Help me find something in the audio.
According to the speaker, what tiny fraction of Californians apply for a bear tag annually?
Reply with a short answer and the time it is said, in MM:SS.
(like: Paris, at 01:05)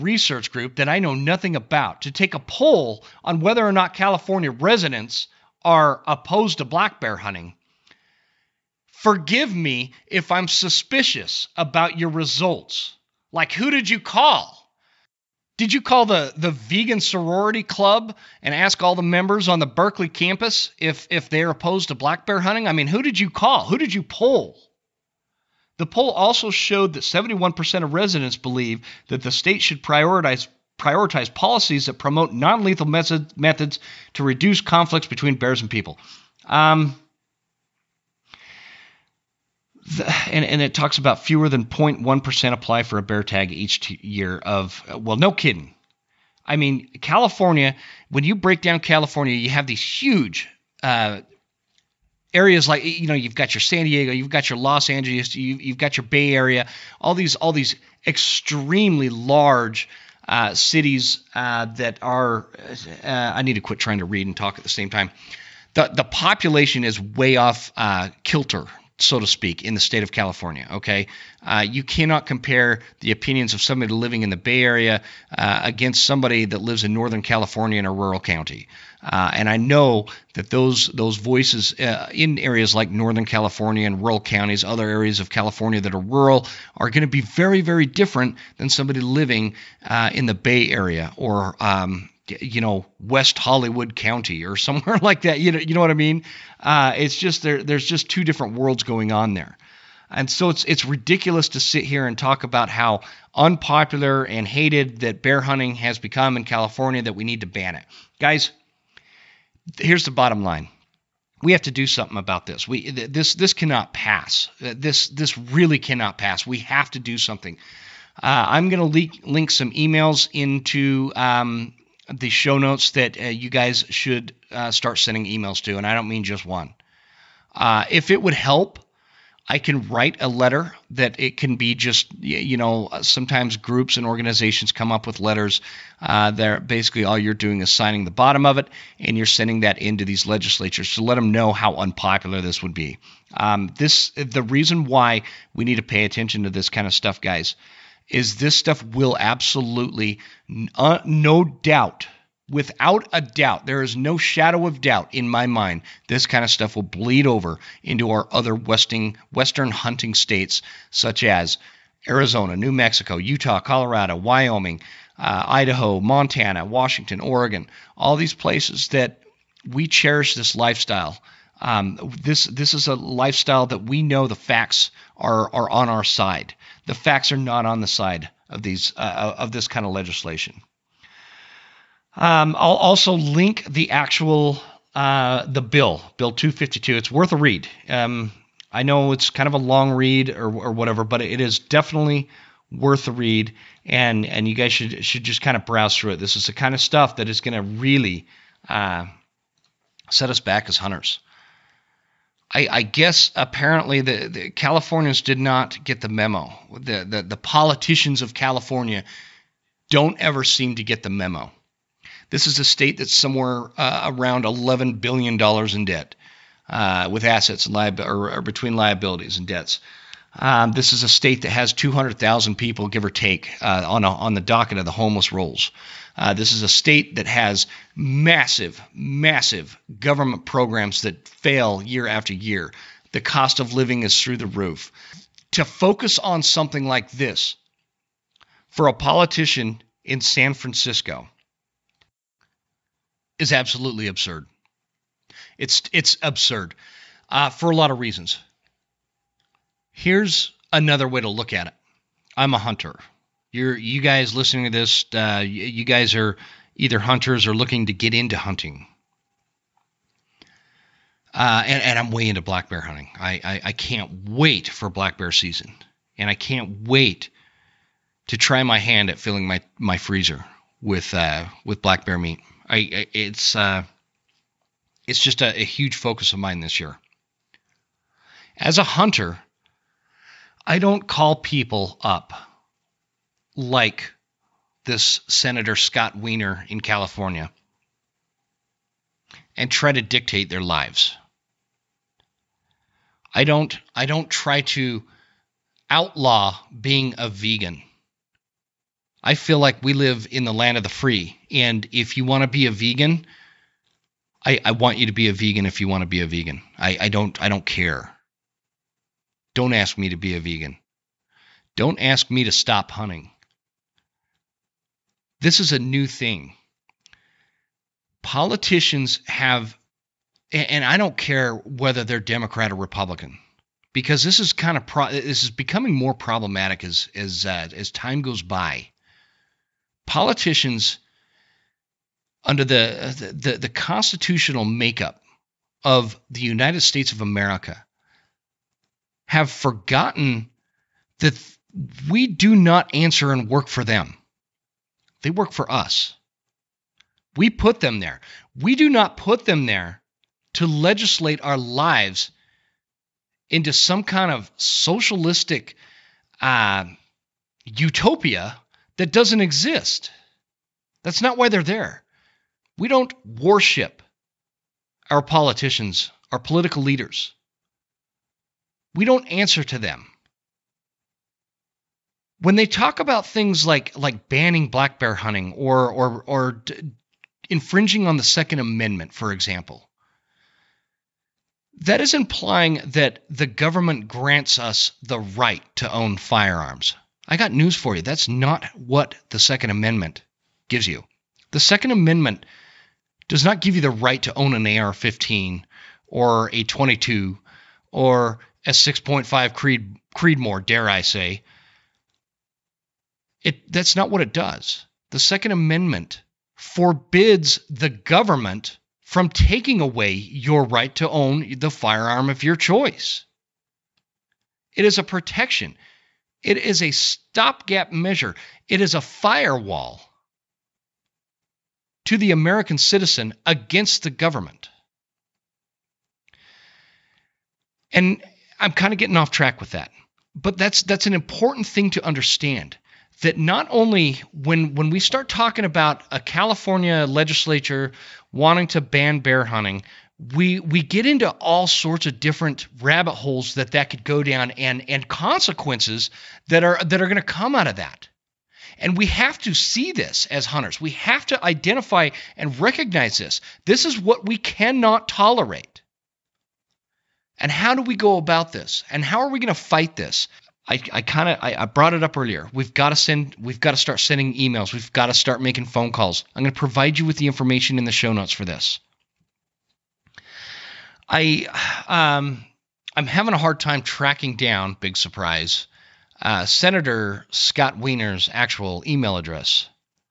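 fewer than 0.1%, at 00:41.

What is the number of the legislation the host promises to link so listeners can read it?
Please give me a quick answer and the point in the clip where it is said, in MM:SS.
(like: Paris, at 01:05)
252, at 03:06.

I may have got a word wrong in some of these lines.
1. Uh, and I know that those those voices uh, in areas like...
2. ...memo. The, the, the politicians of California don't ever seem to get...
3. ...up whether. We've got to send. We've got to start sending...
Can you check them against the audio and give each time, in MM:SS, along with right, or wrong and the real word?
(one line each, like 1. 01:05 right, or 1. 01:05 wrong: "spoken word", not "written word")
1. 01:19 right
2. 03:26 right
3. 07:42 wrong: "earlier", not "whether".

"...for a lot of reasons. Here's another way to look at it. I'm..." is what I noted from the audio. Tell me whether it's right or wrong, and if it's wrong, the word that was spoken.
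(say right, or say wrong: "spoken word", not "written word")
right.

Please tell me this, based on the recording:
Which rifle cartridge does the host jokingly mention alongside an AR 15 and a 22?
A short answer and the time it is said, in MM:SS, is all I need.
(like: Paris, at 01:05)
6.5 Creedmoor, at 06:38.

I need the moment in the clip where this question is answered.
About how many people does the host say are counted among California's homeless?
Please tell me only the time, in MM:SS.
03:41.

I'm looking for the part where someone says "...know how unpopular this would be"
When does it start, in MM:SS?
02:21.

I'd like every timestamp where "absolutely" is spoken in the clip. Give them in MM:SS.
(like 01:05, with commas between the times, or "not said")
02:29, 04:03.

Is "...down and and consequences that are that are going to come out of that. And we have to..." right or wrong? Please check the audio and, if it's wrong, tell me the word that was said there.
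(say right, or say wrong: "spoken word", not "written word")
right.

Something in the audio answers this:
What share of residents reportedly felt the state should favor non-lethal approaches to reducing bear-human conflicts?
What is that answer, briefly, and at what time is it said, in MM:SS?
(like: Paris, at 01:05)
71%, at 00:27.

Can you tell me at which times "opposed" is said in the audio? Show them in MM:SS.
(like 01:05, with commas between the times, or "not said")
00:06, 00:21.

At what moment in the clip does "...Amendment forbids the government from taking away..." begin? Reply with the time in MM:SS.
06:45.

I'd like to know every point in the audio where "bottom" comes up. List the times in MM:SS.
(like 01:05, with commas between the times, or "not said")
01:50, 02:18.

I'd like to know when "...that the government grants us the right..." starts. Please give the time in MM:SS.
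06:22.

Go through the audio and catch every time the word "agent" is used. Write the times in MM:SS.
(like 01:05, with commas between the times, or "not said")
not said.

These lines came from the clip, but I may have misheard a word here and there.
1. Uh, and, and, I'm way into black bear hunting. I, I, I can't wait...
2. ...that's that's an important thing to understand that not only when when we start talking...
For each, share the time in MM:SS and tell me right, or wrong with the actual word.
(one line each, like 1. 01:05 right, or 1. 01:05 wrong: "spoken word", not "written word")
1. 04:21 right
2. 07:10 right.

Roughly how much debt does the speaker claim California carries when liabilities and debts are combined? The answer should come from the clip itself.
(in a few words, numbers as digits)
11 billion dollars.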